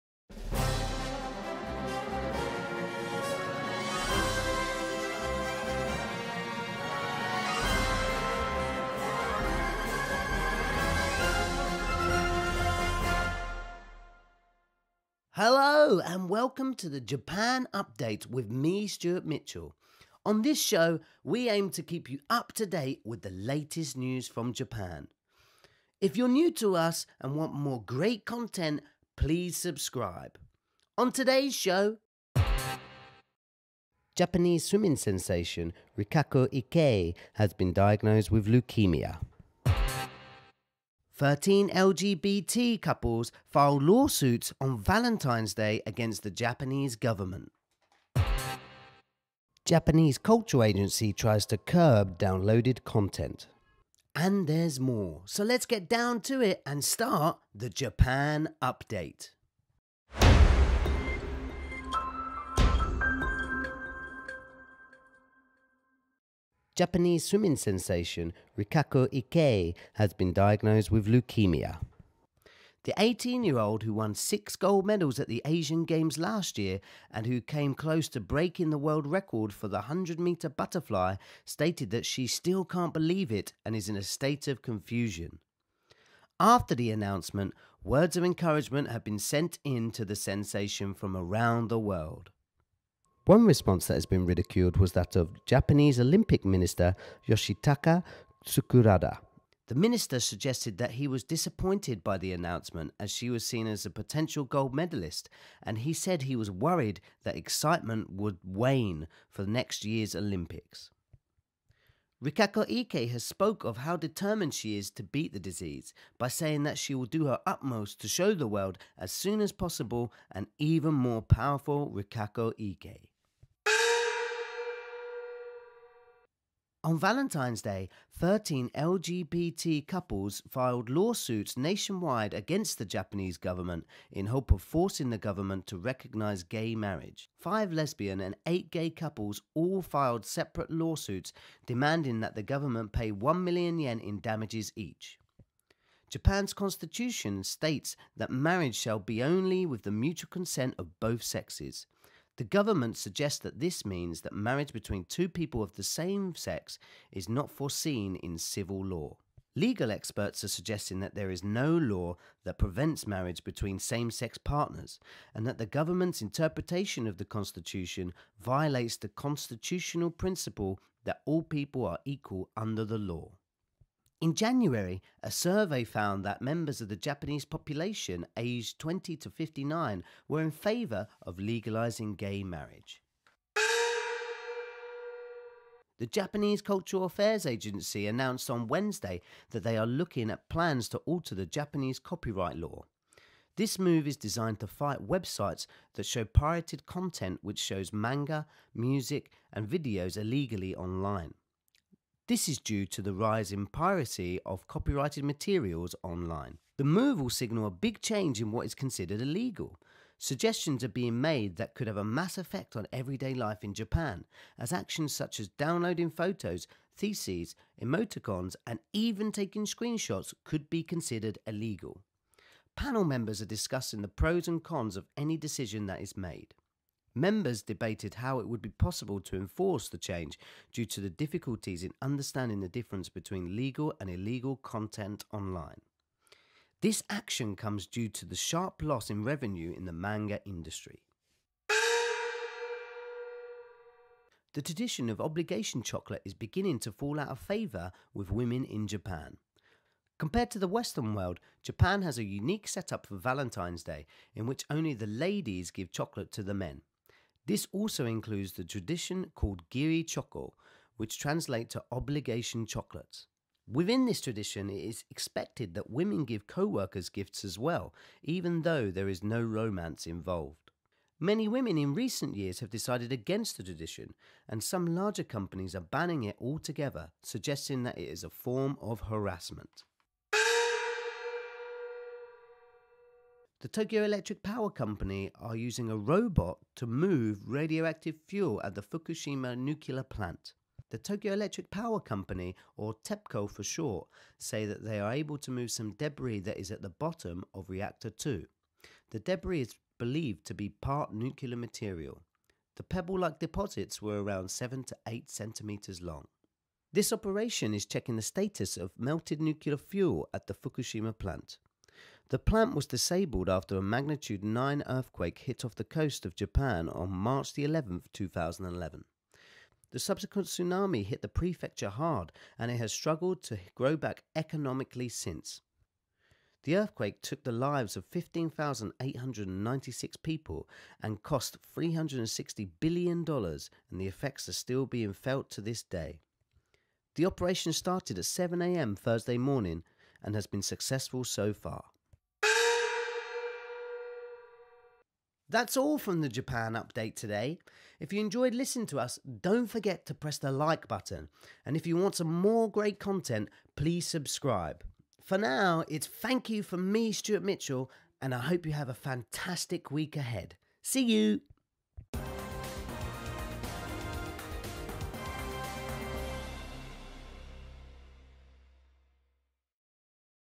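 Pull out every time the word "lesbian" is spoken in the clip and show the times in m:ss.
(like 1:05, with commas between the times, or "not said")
2:17.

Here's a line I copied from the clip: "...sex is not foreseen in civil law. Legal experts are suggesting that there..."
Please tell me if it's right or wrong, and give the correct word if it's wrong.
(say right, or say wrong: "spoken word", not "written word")
right.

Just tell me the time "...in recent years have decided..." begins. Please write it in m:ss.
4:31.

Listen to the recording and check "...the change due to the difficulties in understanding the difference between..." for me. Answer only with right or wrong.
right.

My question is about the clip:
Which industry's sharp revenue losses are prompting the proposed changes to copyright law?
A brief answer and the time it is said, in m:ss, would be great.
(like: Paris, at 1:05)
manga industry, at 3:59.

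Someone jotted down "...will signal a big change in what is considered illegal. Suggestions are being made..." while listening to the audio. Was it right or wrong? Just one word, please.
right.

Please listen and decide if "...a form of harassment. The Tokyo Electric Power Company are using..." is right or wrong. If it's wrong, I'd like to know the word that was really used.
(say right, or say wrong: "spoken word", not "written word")
right.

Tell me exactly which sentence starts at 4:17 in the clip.
This also includes the tradition called giri choco, which translates to obligation chocolates.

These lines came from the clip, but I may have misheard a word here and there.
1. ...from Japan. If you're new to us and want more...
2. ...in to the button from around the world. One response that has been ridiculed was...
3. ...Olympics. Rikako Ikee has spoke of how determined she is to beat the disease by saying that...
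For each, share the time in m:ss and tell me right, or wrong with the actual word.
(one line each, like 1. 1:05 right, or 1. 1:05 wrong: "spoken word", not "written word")
1. 0:24 right
2. 1:29 wrong: "sensation", not "button"
3. 1:50 right.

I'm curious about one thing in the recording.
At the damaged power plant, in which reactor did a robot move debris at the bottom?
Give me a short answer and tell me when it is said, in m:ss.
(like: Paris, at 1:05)
reactor 2, at 4:57.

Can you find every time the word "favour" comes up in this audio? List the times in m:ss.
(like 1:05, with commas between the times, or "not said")
3:00, 4:07.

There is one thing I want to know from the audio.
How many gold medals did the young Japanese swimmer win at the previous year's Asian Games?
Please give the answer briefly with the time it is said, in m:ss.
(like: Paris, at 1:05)
6, at 1:14.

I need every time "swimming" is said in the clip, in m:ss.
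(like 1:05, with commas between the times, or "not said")
0:34, 1:07.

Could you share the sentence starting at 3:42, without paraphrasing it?
Panel members are discussing the pros and cons of any decision that is made.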